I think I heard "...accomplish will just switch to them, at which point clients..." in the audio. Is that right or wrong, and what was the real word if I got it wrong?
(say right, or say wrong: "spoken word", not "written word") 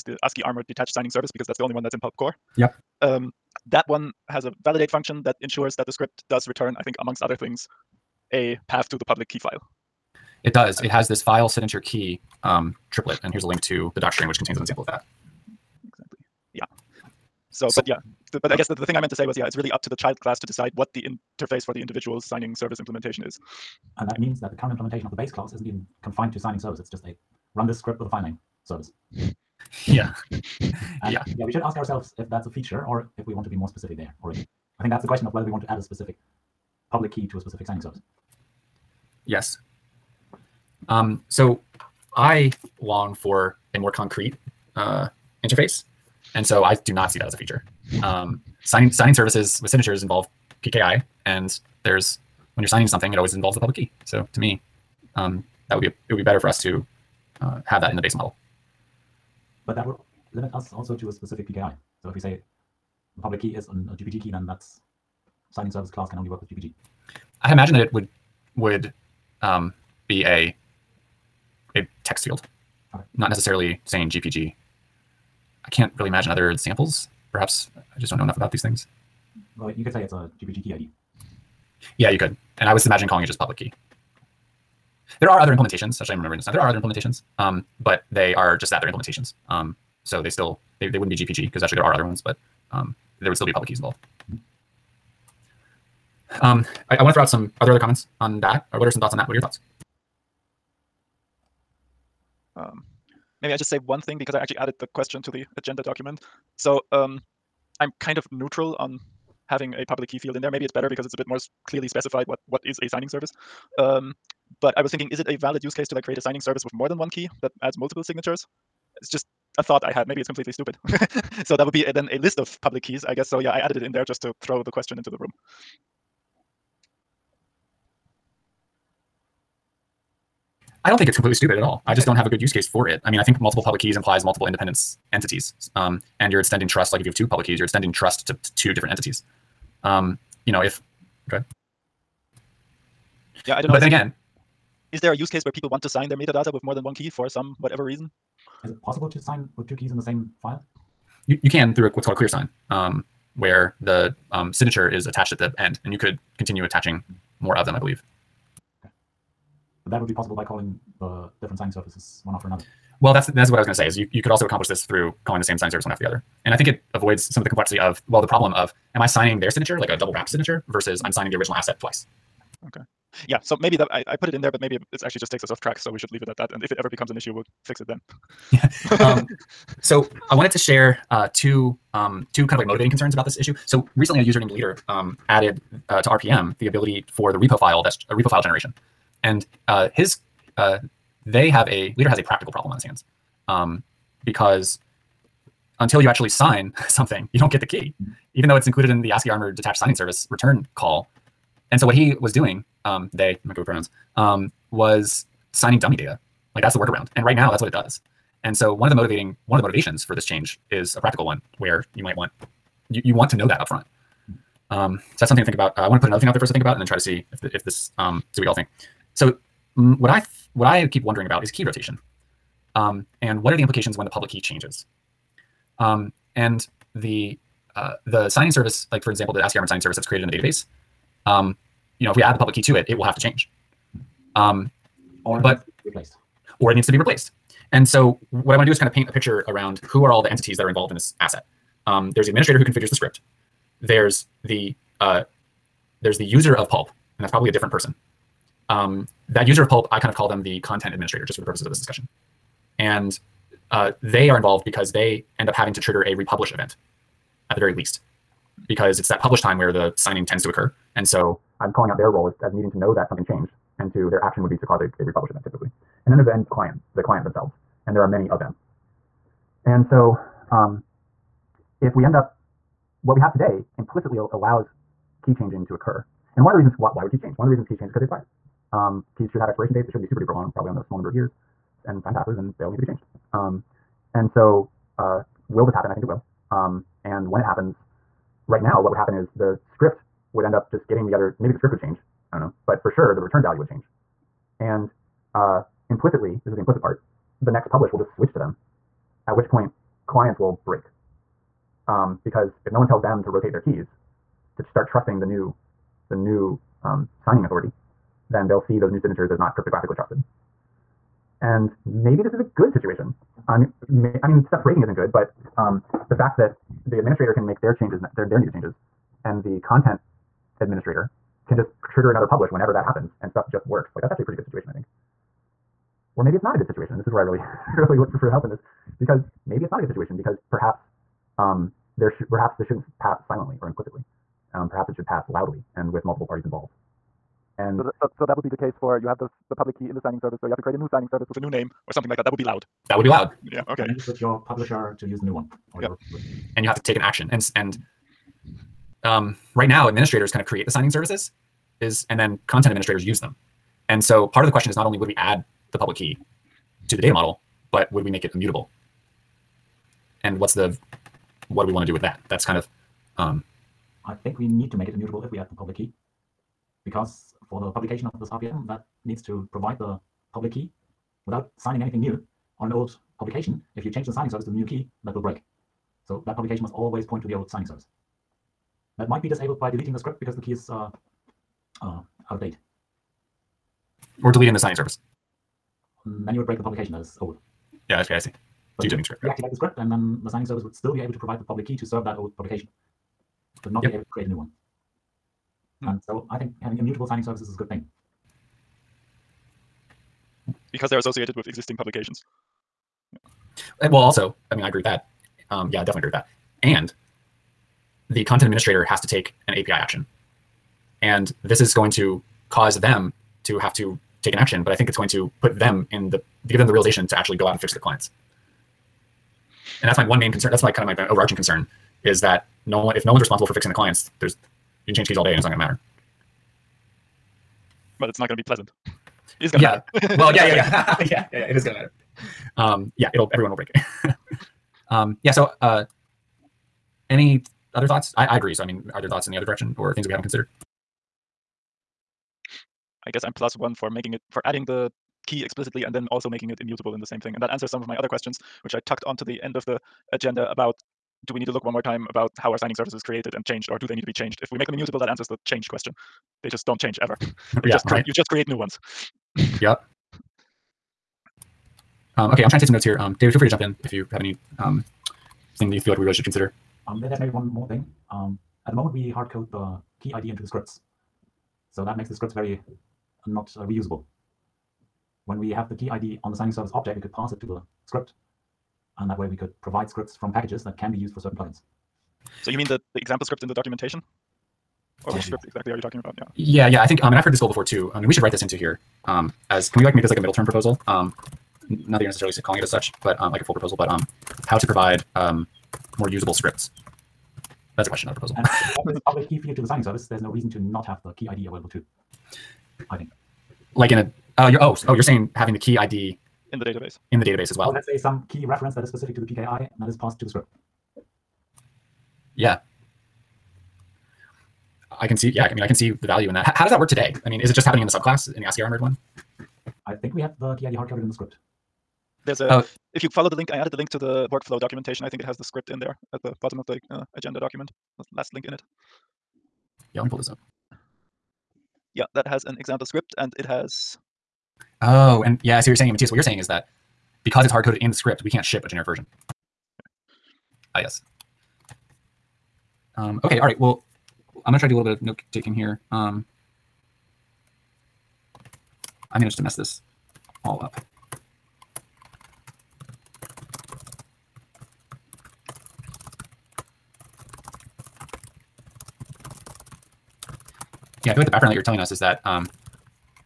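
wrong: "publish", not "accomplish".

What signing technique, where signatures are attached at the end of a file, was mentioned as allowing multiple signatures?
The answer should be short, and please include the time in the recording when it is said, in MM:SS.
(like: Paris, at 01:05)
clear sign, at 02:32.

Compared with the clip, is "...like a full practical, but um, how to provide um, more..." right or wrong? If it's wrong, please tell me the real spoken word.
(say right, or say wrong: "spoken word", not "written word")
wrong: "proposal", not "practical".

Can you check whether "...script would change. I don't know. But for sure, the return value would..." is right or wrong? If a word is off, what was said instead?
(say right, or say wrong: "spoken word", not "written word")
right.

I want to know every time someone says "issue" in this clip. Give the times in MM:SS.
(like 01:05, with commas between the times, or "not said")
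02:57, 03:03.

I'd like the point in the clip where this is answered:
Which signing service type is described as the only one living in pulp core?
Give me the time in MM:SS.
00:00.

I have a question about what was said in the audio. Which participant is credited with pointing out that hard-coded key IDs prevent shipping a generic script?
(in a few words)
Matthias.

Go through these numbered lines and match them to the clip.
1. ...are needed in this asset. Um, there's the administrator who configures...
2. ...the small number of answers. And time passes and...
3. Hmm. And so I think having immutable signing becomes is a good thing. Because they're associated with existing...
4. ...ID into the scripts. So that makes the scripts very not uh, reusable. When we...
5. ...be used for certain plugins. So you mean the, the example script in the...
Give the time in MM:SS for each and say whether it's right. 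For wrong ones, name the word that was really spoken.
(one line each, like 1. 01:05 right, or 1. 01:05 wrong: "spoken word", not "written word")
1. 04:00 wrong: "involved", not "needed"
2. 04:40 wrong: "years", not "answers"
3. 06:35 wrong: "services", not "becomes"
4. 07:50 right
5. 08:00 right.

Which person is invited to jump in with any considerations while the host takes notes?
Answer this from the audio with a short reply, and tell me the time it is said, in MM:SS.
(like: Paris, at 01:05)
David, at 07:43.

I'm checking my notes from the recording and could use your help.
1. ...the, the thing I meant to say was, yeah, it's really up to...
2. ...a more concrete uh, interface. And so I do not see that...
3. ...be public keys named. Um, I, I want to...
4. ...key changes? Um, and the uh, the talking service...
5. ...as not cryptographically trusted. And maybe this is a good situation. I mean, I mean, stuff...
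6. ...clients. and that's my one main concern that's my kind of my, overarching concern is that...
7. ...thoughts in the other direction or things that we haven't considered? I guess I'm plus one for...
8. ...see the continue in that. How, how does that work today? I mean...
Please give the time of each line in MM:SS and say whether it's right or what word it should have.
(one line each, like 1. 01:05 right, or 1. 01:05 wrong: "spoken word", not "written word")
1. 00:18 right
2. 00:43 right
3. 01:33 wrong: "involved", not "named"
4. 03:44 wrong: "signing", not "talking"
5. 05:09 right
6. 06:57 right
7. 07:19 right
8. 08:35 wrong: "value", not "continue".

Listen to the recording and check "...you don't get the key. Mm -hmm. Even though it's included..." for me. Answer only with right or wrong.
right.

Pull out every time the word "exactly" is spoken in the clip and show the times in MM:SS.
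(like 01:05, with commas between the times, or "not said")
00:15, 08:05.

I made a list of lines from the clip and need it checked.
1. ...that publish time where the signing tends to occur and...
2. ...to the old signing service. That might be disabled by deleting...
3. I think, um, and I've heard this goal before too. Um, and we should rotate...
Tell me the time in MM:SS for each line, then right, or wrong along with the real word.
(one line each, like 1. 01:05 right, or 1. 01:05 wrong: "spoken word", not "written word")
1. 04:19 right
2. 06:17 right
3. 08:06 wrong: "write", not "rotate".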